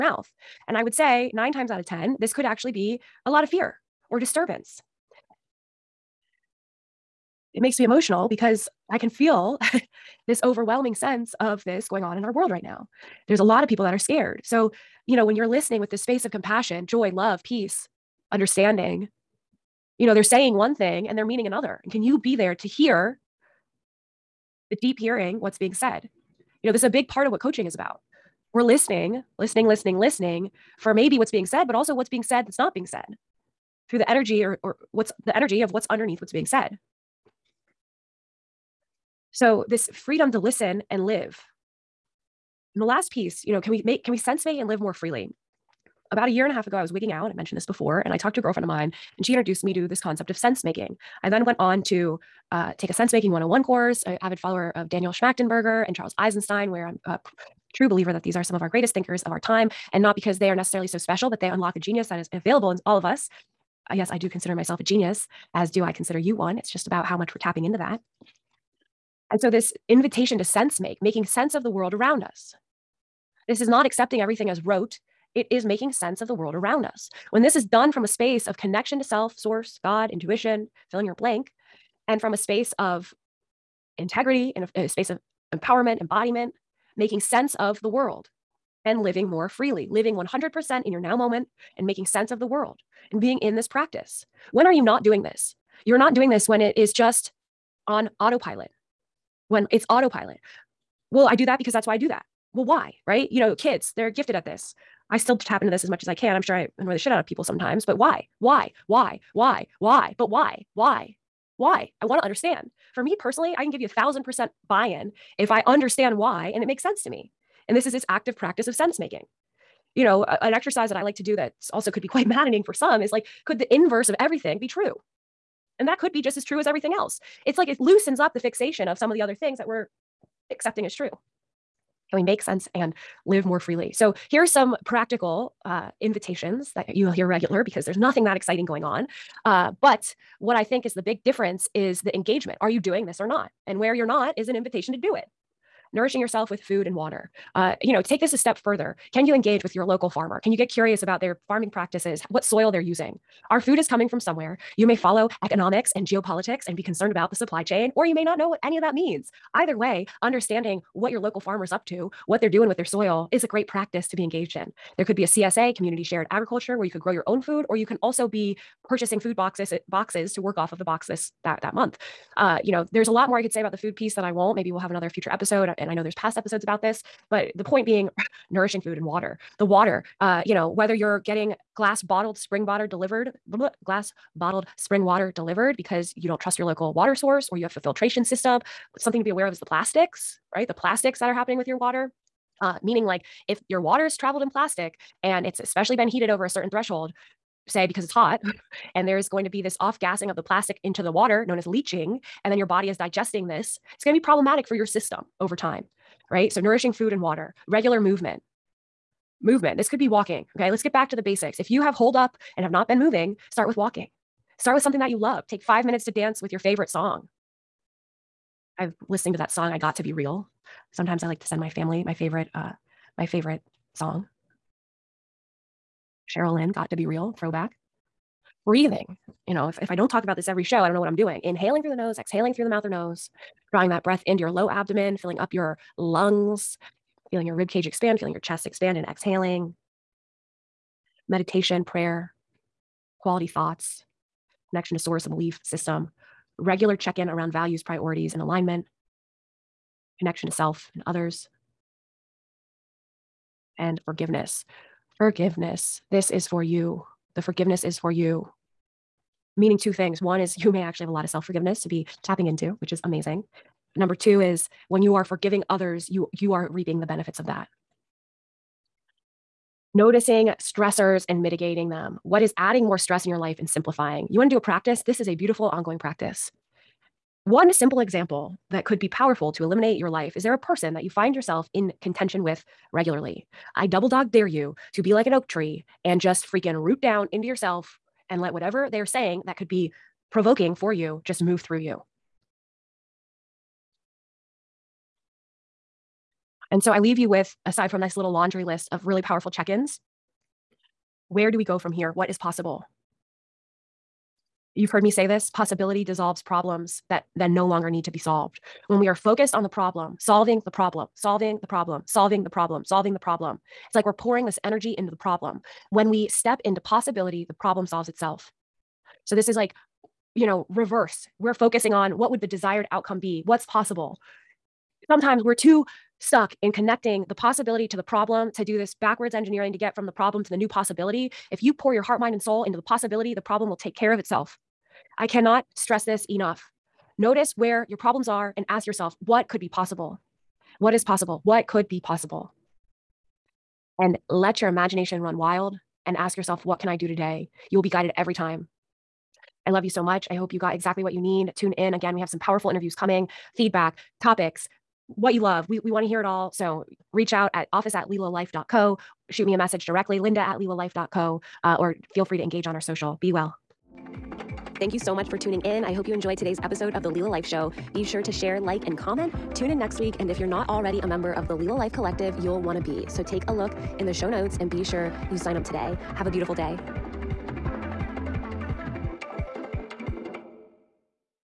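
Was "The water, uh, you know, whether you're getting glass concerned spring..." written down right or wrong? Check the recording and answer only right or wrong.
wrong.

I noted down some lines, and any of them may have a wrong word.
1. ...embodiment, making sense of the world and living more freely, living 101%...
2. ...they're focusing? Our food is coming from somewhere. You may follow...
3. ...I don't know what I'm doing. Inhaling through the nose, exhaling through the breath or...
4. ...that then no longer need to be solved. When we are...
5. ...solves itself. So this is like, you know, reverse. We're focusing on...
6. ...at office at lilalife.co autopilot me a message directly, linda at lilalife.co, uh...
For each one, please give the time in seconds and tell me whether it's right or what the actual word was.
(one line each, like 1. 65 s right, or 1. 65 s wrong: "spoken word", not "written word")
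1. 86 s wrong: "100", not "101"
2. 152 s wrong: "using", not "focusing"
3. 230 s wrong: "mouth", not "breath"
4. 307 s right
5. 317 s right
6. 357 s wrong: "shoot", not "autopilot".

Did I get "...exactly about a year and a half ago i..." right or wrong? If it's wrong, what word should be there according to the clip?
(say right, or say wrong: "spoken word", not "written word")
wrong: "freely", not "exactly".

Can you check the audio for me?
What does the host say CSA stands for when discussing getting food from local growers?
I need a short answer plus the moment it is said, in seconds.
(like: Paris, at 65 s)
community shared agriculture, at 165 s.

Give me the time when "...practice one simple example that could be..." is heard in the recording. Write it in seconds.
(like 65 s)
275 s.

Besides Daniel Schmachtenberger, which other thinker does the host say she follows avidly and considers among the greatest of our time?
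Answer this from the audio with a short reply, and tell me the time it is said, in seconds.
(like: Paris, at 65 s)
Charles Eisenstein, at 55 s.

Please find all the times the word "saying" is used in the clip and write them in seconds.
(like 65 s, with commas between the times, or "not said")
20 s, 289 s.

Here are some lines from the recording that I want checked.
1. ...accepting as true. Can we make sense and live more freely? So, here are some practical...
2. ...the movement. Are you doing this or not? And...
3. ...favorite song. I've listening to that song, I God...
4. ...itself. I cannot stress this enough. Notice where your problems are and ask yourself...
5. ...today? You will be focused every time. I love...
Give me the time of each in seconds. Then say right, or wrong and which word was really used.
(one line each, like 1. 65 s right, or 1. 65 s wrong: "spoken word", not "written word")
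1. 130 s right
2. 142 s wrong: "engagement", not "movement"
3. 216 s wrong: "Got", not "God"
4. 334 s right
5. 347 s wrong: "guided", not "focused".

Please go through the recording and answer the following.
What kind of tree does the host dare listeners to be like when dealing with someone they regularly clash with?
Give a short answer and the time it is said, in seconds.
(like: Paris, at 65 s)
an oak tree, at 285 s.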